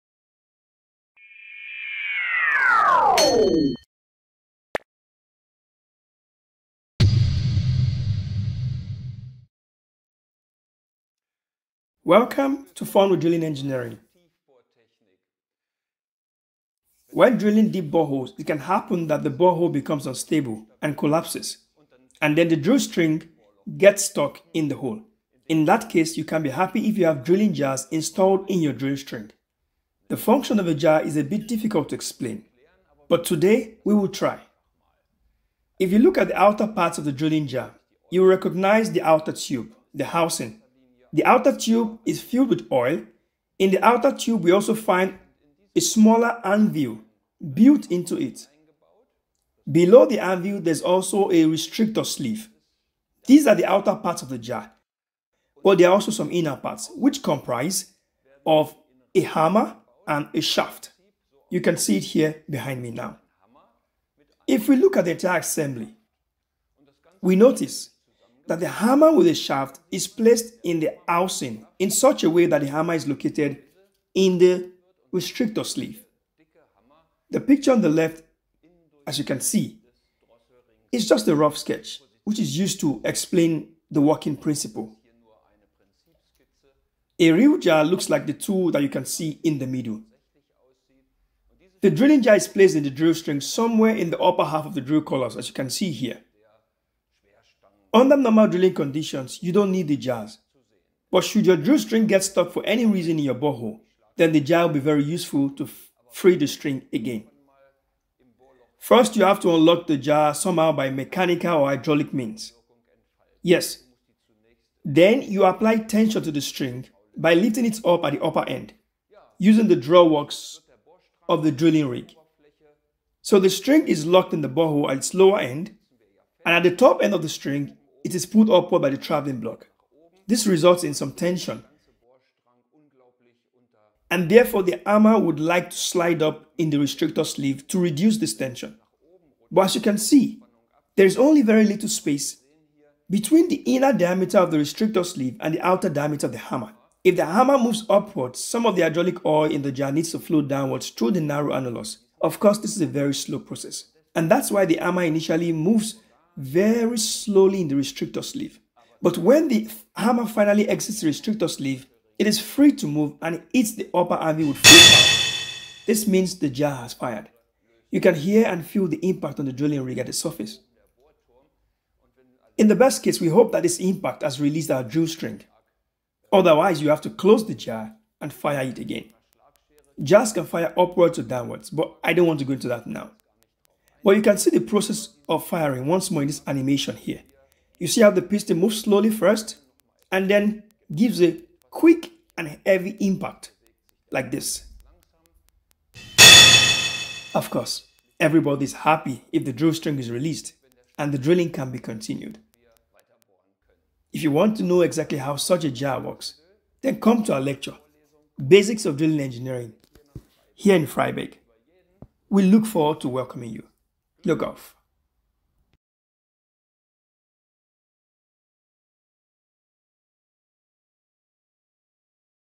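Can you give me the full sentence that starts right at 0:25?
In that case, you can be happy if you have drilling jars installed in your drill string.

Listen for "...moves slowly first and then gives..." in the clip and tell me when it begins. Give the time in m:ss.
3:08.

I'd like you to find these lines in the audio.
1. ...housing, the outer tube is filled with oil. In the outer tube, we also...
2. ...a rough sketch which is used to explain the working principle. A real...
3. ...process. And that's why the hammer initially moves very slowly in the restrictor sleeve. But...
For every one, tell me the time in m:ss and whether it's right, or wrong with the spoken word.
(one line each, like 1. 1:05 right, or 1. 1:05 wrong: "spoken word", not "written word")
1. 0:40 right
2. 1:21 right
3. 2:33 right.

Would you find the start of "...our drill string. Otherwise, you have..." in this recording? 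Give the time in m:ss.
2:54.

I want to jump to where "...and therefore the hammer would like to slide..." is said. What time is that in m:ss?
2:14.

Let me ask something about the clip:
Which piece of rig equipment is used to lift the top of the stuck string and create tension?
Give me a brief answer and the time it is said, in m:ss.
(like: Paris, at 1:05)
The drawworks, at 1:59.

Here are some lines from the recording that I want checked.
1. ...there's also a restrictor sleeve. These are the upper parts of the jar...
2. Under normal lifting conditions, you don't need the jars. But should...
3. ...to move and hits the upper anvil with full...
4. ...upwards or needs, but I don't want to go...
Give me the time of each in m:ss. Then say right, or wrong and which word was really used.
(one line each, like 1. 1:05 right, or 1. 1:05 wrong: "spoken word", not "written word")
1. 0:50 wrong: "outer", not "upper"
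2. 1:37 wrong: "drilling", not "lifting"
3. 2:42 right
4. 3:00 wrong: "downwards", not "needs".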